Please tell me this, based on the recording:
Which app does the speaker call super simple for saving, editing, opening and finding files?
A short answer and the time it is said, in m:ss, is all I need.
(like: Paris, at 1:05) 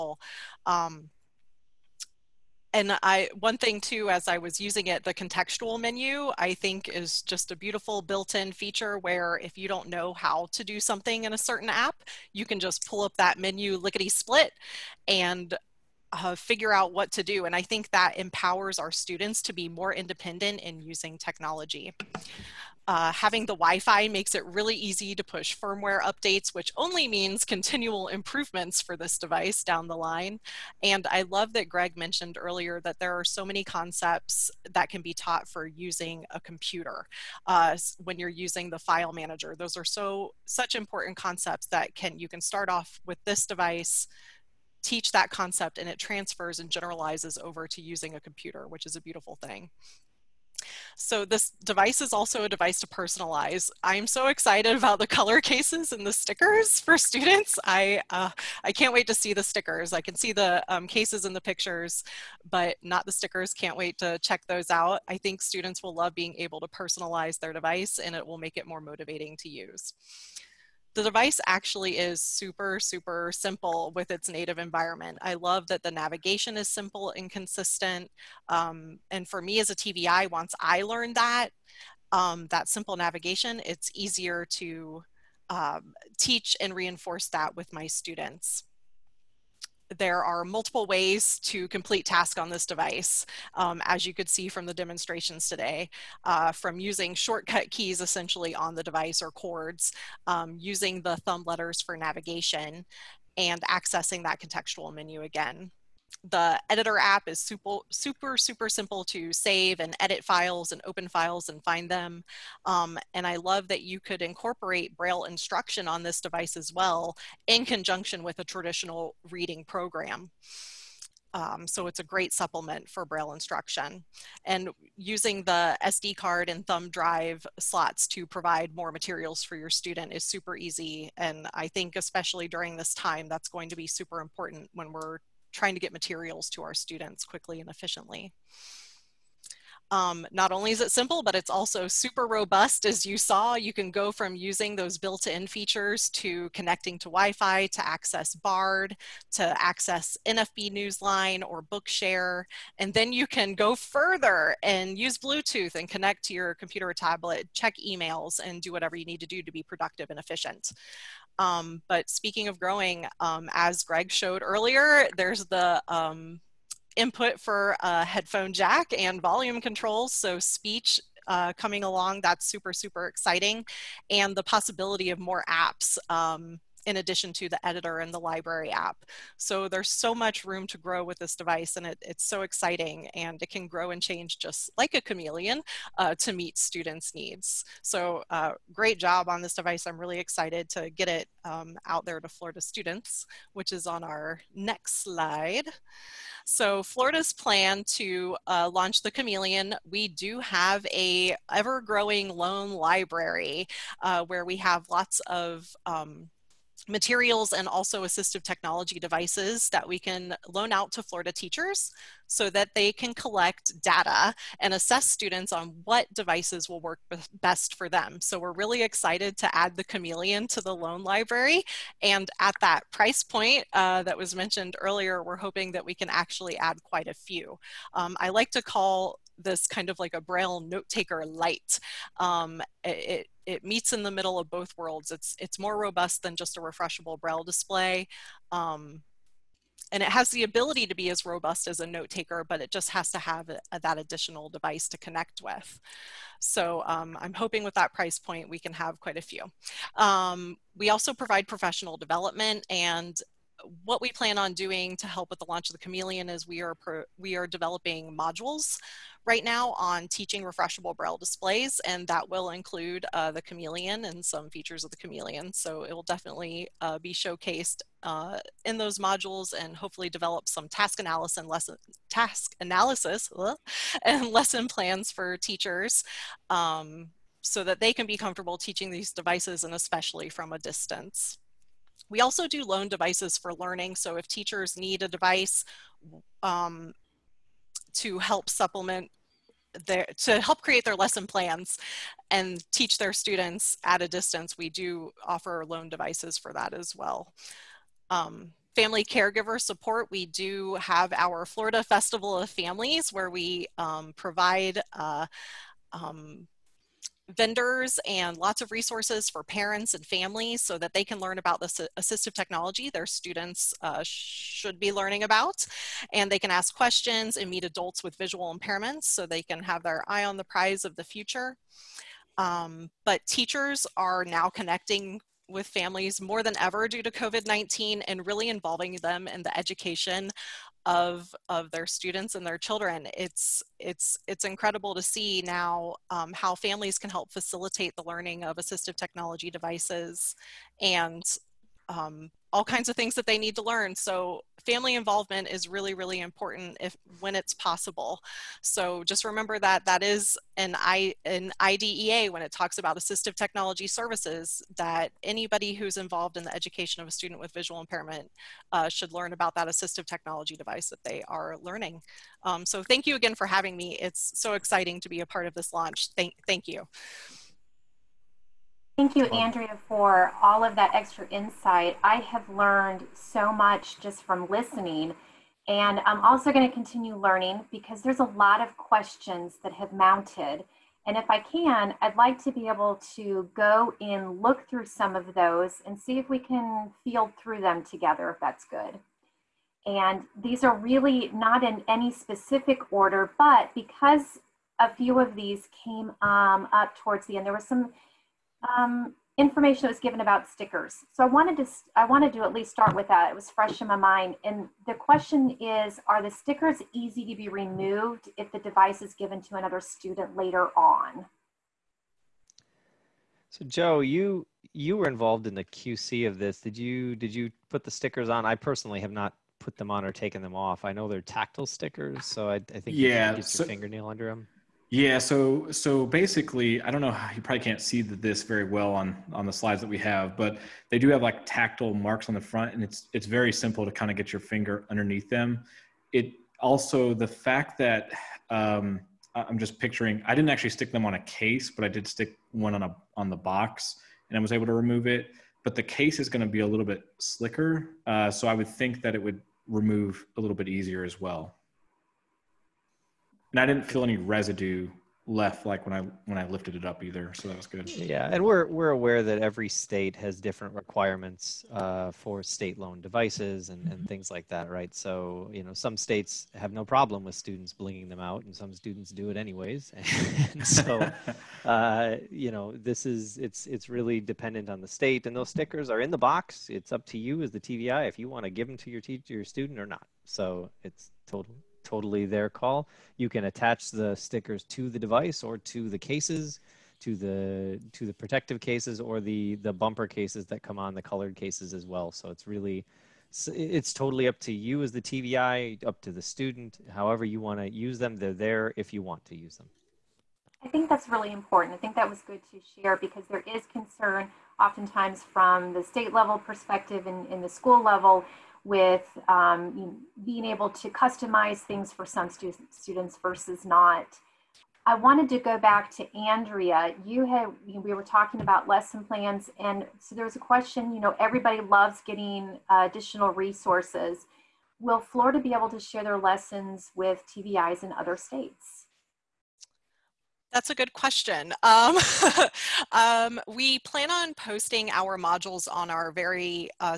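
editor app, at 1:46.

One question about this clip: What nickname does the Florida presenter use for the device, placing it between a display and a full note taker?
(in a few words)
braille note taker light.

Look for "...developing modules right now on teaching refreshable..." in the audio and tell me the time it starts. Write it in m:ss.
4:17.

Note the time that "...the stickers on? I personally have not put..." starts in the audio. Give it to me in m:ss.
6:57.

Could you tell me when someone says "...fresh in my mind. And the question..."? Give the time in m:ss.
6:43.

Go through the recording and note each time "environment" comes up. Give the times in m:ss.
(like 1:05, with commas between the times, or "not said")
1:14.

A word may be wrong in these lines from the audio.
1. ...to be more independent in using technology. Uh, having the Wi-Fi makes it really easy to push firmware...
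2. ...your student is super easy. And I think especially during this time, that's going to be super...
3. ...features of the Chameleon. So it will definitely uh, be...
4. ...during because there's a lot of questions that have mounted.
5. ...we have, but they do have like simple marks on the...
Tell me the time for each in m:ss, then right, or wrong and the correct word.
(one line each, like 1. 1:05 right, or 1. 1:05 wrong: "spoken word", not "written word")
1. 0:19 right
2. 2:09 right
3. 4:24 right
4. 6:17 wrong: "learning", not "during"
5. 7:09 wrong: "tactile", not "simple".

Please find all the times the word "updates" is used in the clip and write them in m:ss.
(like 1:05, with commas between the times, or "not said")
0:26.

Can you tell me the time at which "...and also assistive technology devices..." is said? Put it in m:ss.
3:27.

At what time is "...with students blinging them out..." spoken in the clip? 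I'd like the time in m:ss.
7:47.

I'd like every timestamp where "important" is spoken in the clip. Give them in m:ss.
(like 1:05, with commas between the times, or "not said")
0:40, 2:14, 5:46, 8:21.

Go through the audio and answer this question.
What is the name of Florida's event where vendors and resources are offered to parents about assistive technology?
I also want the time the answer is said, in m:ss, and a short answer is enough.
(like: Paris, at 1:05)
Florida Festival of Families, at 5:01.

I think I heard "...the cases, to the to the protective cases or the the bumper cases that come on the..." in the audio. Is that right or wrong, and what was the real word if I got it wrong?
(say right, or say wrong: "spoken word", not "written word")
right.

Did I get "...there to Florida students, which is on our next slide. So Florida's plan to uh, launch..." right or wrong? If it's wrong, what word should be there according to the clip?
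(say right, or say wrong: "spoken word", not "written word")
right.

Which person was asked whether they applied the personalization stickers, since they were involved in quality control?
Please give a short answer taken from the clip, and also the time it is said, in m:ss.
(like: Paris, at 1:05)
Joe, at 6:53.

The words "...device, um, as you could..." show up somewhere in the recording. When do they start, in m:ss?
1:32.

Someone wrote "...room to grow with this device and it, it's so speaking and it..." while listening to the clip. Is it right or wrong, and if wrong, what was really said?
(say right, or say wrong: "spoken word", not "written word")
wrong: "exciting", not "speaking".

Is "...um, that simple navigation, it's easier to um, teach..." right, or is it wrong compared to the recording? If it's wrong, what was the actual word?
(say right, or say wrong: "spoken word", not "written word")
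right.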